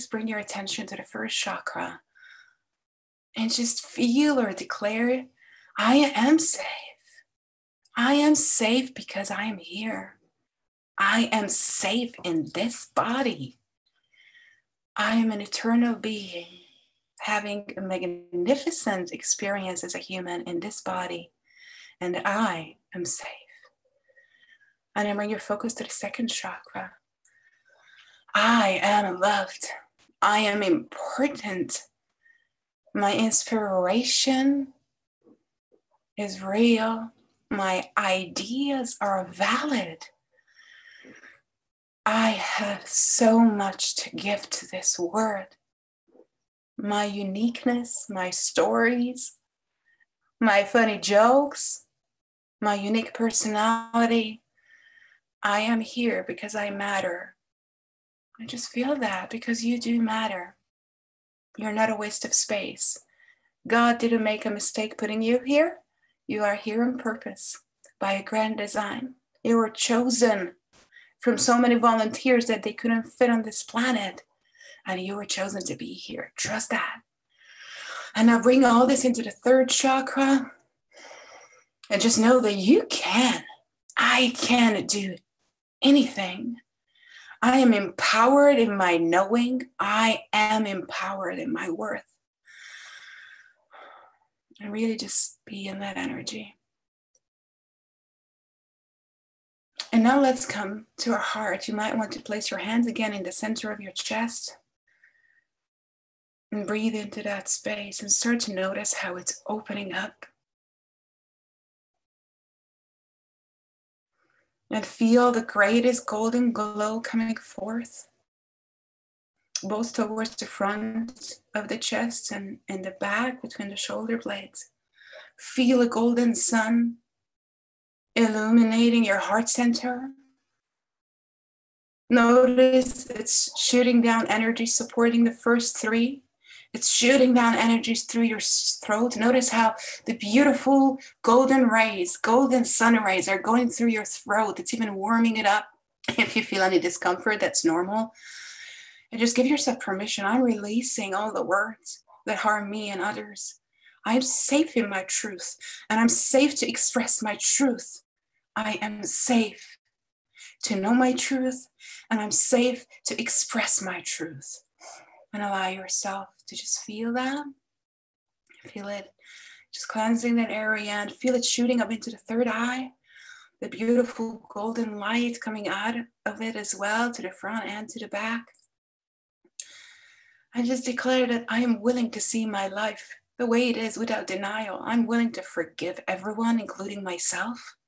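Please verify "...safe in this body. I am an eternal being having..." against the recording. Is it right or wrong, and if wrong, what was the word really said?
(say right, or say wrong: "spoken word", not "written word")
right.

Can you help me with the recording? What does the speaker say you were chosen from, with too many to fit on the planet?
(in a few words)
volunteers.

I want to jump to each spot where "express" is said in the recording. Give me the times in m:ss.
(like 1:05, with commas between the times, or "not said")
2:36, 2:43.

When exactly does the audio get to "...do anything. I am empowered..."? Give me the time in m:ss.
1:24.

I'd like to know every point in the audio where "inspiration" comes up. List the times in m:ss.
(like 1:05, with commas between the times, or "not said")
0:33.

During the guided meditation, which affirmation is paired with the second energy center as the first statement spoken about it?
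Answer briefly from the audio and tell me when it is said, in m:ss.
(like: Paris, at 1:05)
I am loved, at 0:28.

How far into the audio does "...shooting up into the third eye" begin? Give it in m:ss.
2:51.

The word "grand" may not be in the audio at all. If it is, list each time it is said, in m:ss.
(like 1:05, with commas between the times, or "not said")
1:08.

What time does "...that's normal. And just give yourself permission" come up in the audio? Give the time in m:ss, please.
2:27.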